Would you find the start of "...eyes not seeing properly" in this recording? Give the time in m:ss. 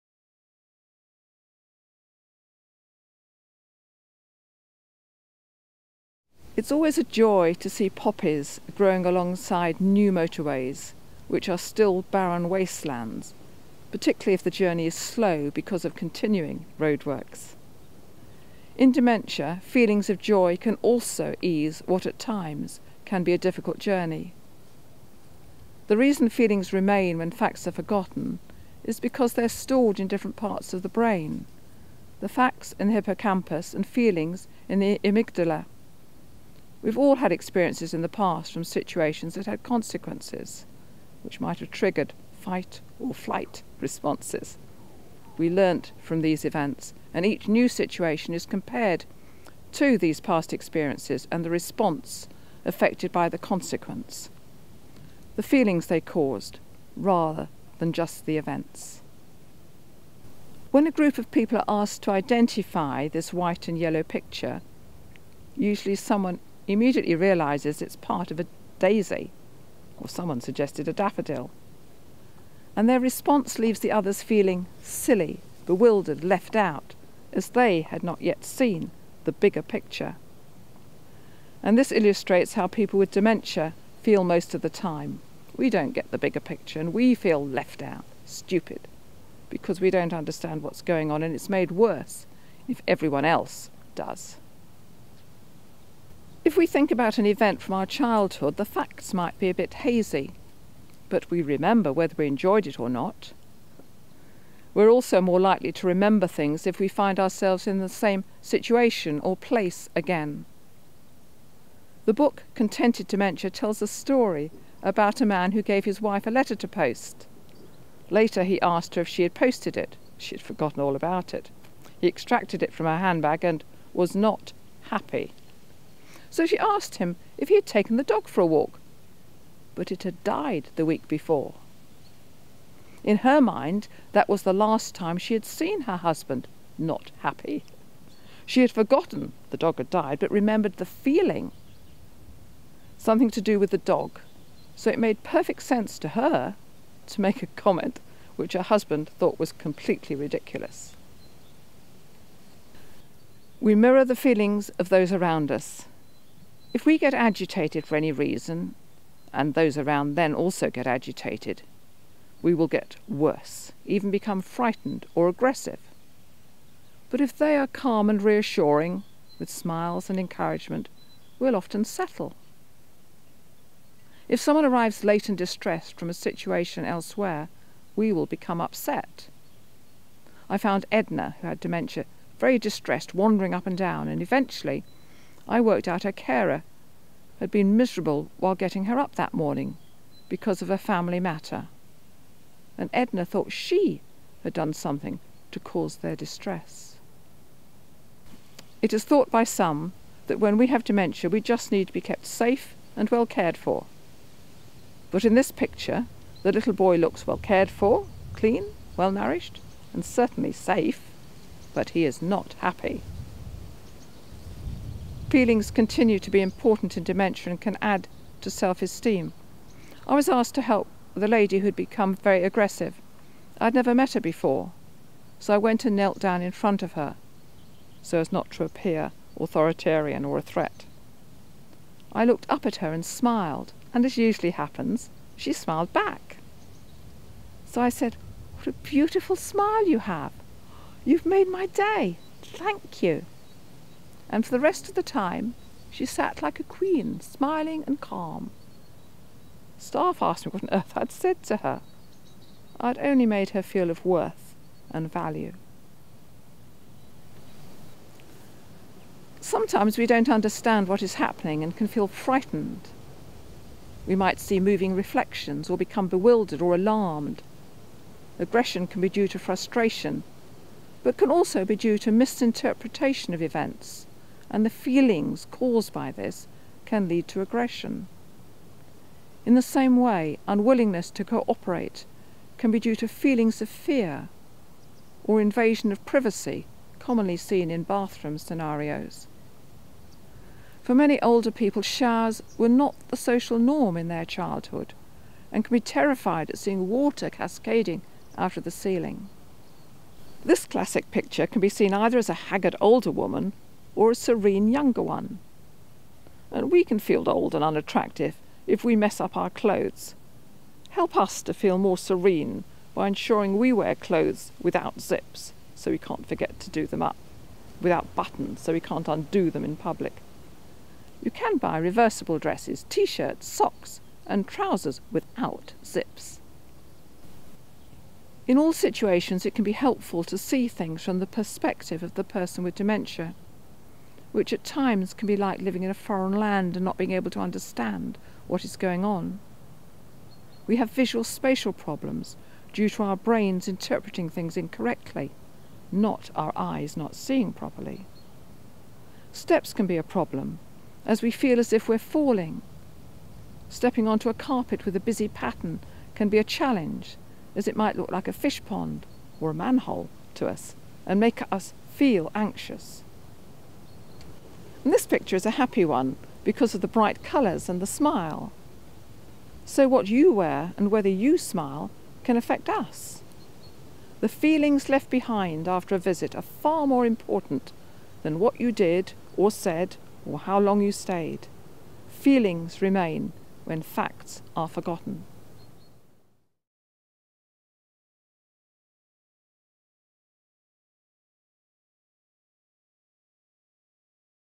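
5:46.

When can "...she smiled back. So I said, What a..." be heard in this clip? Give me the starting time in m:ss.
3:55.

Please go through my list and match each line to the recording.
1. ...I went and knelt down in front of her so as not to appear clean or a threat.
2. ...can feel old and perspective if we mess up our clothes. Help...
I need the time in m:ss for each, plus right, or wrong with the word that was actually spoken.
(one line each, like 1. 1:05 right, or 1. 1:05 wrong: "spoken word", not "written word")
1. 3:45 wrong: "authoritarian", not "clean"
2. 5:06 wrong: "unattractive", not "perspective".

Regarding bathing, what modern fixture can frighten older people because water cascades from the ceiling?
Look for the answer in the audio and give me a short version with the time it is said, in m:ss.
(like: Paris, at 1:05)
showers, at 4:51.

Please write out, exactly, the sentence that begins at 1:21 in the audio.
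And this illustrates how people with dementia feel most of the time.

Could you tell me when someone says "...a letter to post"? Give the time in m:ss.
1:56.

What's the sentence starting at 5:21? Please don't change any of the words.
You can buy reversible dresses, t shirts, socks, and trousers without zips.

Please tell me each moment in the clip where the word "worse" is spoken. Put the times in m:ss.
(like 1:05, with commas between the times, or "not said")
1:31, 2:43.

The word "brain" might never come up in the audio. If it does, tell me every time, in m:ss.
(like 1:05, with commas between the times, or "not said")
0:30, 5:43.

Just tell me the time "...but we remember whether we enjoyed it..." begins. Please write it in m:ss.
1:41.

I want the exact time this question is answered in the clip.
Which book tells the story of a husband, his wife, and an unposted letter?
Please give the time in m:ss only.
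1:52.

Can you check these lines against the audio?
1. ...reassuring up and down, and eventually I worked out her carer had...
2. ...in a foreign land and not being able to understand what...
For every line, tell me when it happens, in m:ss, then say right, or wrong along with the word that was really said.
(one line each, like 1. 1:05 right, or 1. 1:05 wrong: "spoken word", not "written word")
1. 3:03 wrong: "wandering", not "reassuring"
2. 5:35 right.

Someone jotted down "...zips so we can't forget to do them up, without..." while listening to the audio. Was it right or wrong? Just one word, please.
right.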